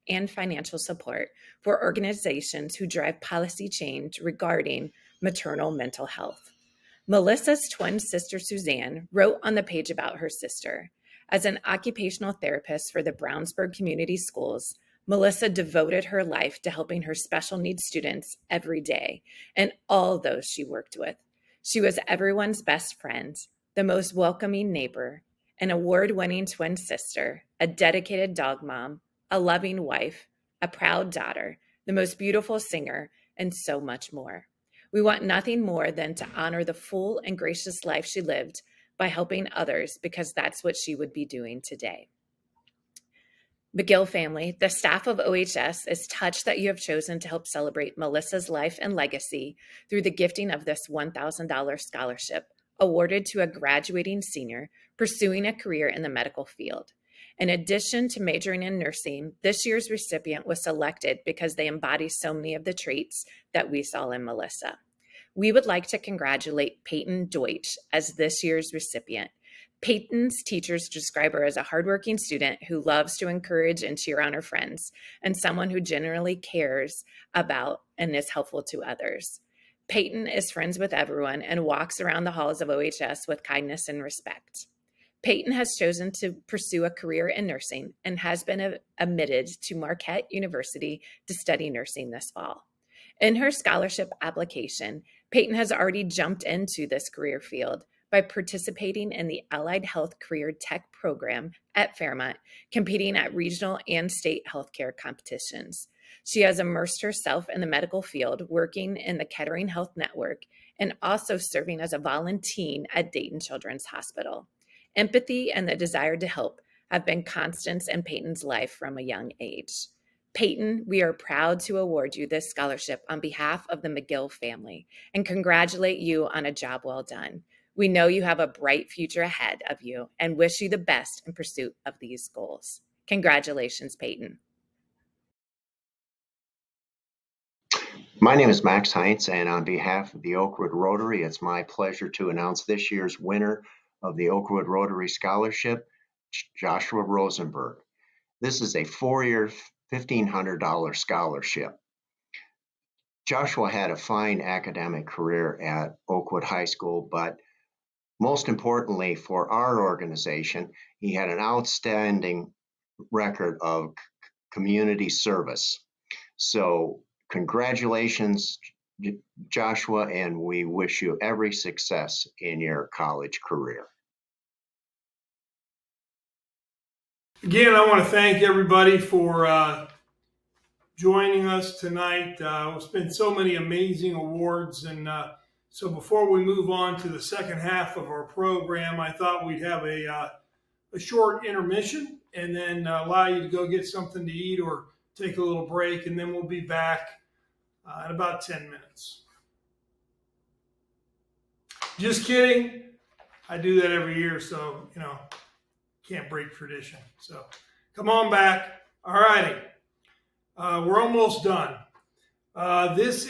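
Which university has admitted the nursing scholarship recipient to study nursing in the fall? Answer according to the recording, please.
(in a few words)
Marquette University.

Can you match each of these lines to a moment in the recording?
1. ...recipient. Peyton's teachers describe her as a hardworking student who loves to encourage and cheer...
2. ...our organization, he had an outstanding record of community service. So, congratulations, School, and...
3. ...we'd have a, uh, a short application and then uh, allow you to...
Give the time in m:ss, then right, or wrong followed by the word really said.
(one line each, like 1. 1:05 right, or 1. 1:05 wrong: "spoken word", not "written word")
1. 1:08 right
2. 2:39 wrong: "Joshua", not "School"
3. 3:09 wrong: "intermission", not "application".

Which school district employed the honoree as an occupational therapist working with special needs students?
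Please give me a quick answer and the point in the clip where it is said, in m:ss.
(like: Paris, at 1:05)
Brownsburg Community Schools, at 0:13.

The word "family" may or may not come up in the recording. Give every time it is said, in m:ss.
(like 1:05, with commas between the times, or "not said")
0:44, 2:04.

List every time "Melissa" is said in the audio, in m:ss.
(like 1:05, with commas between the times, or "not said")
0:07, 0:15, 0:47, 1:04.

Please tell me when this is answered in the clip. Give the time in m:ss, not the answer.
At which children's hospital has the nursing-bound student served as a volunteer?
1:53.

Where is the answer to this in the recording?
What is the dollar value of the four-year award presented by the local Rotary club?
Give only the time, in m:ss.
2:29.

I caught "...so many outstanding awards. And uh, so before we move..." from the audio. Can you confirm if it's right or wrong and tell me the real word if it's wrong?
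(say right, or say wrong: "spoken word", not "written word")
wrong: "amazing", not "outstanding".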